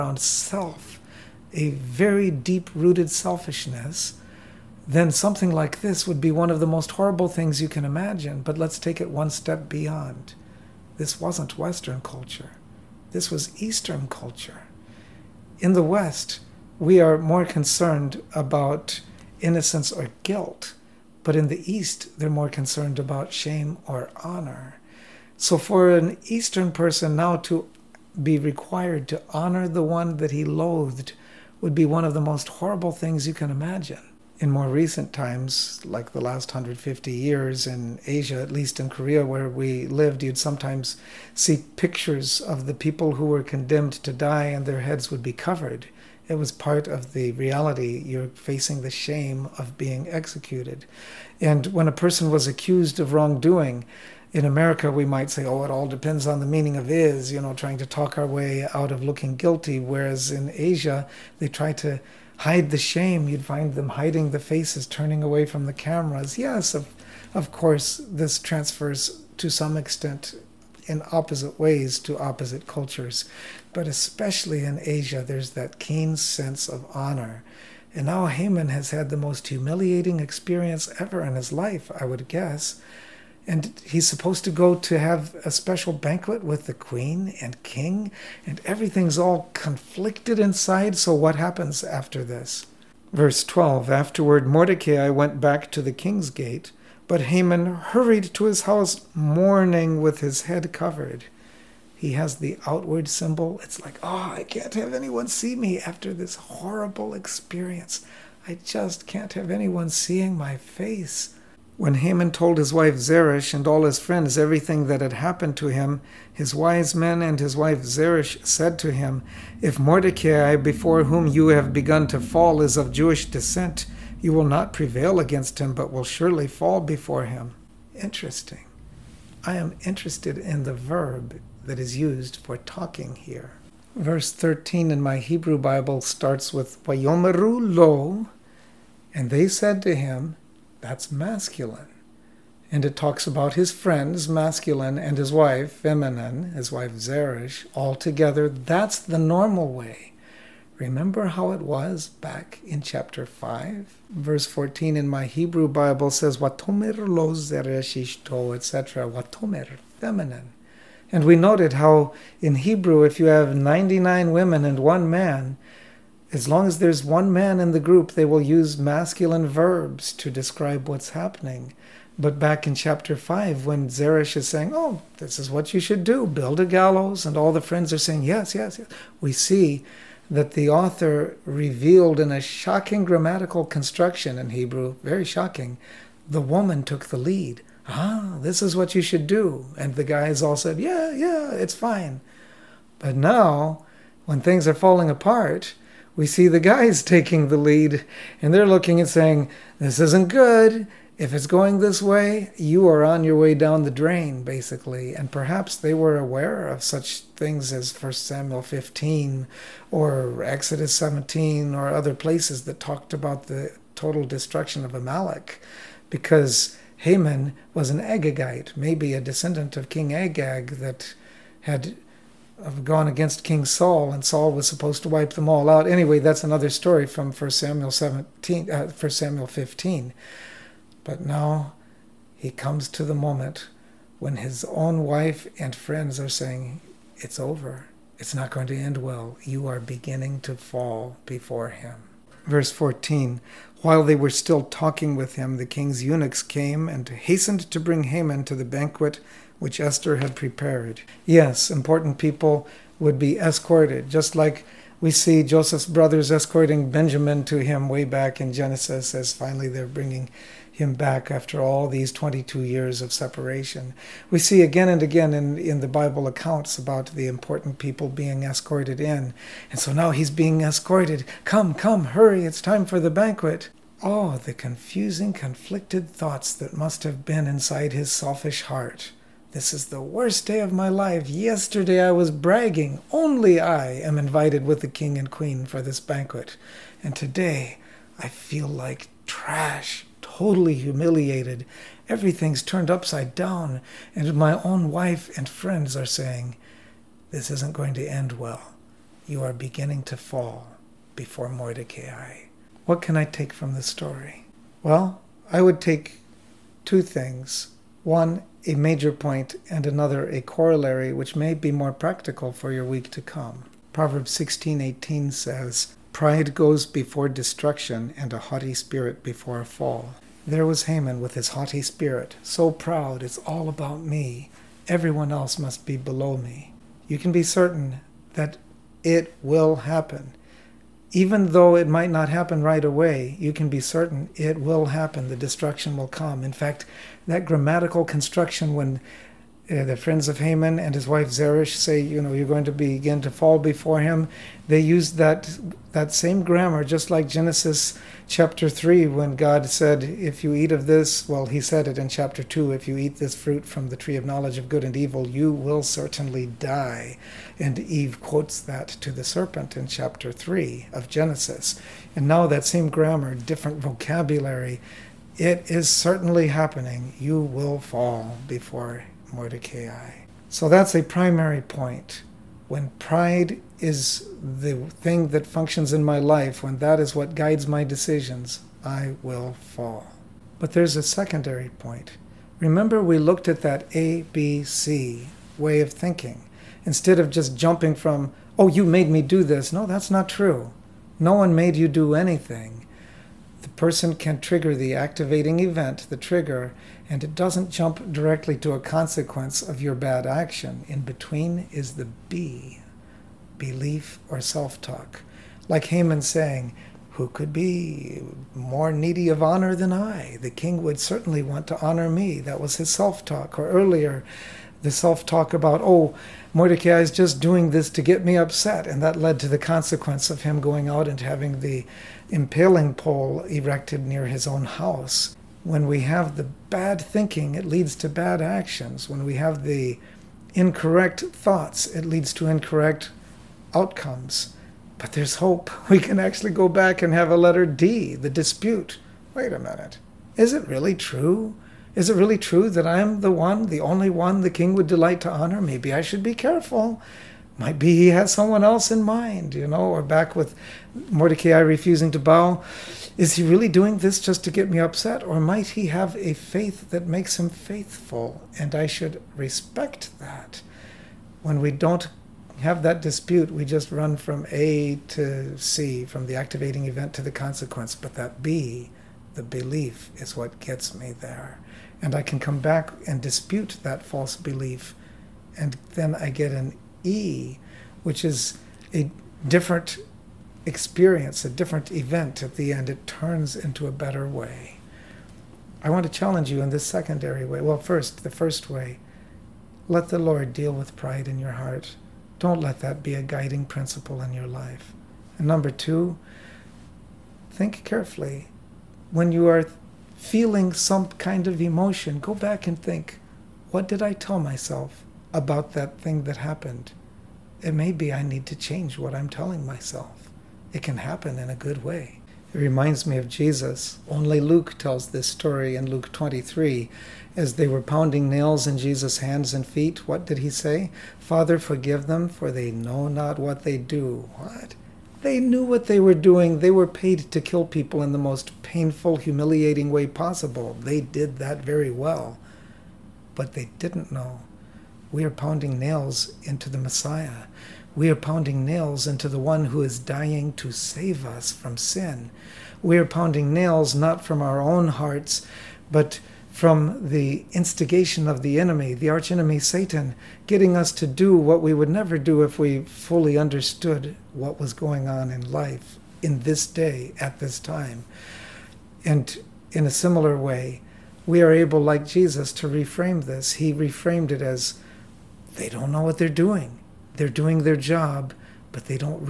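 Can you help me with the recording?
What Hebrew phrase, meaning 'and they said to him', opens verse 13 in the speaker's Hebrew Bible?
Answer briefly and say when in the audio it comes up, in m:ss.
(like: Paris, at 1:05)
Vayomeru lo, at 2:16.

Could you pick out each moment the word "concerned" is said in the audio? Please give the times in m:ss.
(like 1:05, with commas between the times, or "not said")
0:17, 0:22.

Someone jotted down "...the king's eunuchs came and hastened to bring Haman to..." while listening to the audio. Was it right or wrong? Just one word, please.
right.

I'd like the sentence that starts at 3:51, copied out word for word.
But now he comes to the moment when his own wife and friends are saying, It's over.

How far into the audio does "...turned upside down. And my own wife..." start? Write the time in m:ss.
4:52.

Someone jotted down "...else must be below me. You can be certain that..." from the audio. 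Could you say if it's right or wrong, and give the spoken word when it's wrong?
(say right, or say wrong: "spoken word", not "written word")
right.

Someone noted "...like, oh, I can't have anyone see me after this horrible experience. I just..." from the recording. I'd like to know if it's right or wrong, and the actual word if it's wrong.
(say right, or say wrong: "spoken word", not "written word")
right.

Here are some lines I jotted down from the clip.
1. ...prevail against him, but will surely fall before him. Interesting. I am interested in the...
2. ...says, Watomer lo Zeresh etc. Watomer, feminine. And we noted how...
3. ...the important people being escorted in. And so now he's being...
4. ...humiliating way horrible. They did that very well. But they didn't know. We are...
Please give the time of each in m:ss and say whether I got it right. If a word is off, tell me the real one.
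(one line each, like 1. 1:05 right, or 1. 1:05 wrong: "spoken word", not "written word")
1. 2:04 right
2. 2:36 right
3. 4:27 right
4. 8:49 wrong: "possible", not "horrible".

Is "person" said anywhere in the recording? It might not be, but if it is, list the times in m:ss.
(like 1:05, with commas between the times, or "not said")
0:26, 0:51, 6:33.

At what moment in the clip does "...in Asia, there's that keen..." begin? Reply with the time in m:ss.
1:14.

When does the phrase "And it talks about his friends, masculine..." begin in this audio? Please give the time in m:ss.
2:22.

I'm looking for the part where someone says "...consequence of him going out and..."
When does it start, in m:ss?
6:59.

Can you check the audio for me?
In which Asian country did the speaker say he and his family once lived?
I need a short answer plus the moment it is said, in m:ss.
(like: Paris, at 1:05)
Korea, at 0:38.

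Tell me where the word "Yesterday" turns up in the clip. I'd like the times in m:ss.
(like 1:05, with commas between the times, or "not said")
4:41.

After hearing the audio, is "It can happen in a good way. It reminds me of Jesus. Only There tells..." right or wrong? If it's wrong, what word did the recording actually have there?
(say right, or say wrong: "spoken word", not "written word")
wrong: "Luke", not "There".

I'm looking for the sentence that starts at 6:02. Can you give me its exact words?
And now that same grammar, different vocabulary.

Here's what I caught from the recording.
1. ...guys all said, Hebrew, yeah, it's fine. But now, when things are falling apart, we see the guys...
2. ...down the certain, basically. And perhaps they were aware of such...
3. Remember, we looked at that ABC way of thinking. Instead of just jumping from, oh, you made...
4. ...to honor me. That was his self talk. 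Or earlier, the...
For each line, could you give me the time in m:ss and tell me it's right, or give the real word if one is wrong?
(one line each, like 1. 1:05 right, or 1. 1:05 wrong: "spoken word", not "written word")
1. 3:10 wrong: "Yeah", not "Hebrew"
2. 3:23 wrong: "drain", not "certain"
3. 6:22 right
4. 6:51 right.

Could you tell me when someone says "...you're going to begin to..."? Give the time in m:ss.
5:42.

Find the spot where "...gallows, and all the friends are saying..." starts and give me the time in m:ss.
2:56.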